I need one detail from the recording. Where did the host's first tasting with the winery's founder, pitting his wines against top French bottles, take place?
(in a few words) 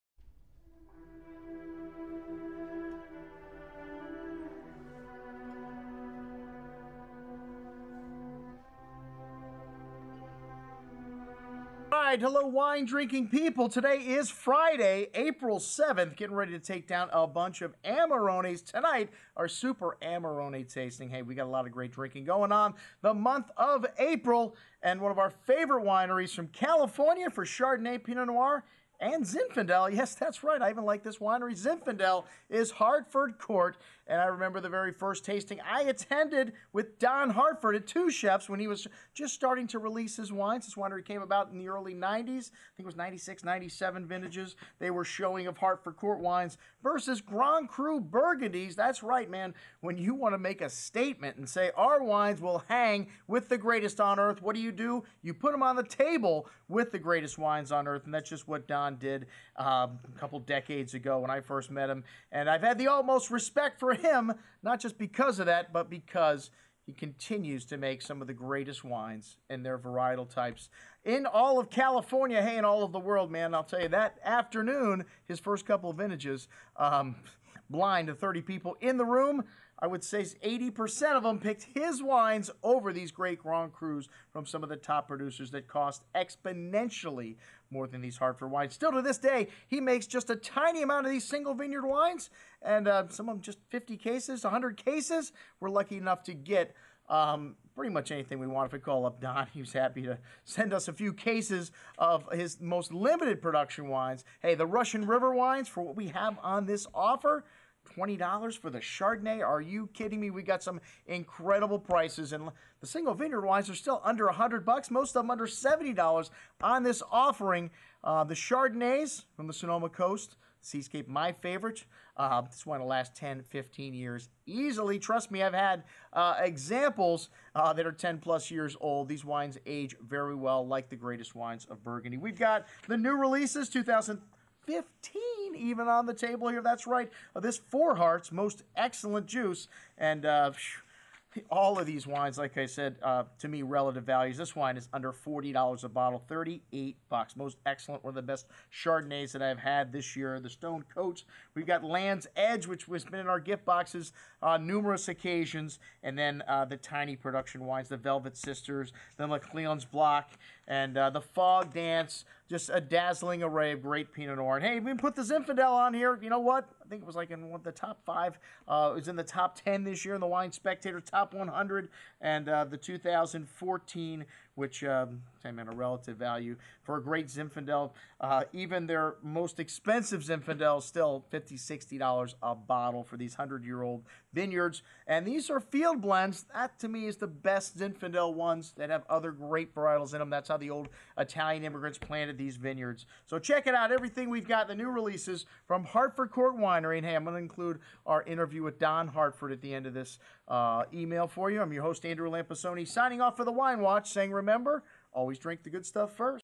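Two Chefs.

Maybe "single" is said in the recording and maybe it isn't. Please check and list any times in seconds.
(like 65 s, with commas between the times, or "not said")
91 s, 112 s.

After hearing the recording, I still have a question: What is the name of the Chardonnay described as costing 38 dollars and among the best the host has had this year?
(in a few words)
Four Hearts.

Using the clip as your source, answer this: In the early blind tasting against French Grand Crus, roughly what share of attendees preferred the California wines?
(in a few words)
80%.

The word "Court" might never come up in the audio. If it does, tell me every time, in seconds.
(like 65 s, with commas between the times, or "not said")
33 s, 45 s, 196 s.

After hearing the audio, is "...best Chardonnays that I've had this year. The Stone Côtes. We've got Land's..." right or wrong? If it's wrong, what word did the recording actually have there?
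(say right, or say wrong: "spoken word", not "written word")
right.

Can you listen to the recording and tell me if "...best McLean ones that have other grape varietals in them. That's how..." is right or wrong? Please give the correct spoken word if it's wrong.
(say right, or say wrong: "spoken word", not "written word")
wrong: "Zinfandel", not "McLean".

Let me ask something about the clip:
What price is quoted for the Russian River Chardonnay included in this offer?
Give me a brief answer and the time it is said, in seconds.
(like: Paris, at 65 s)
$20, at 107 s.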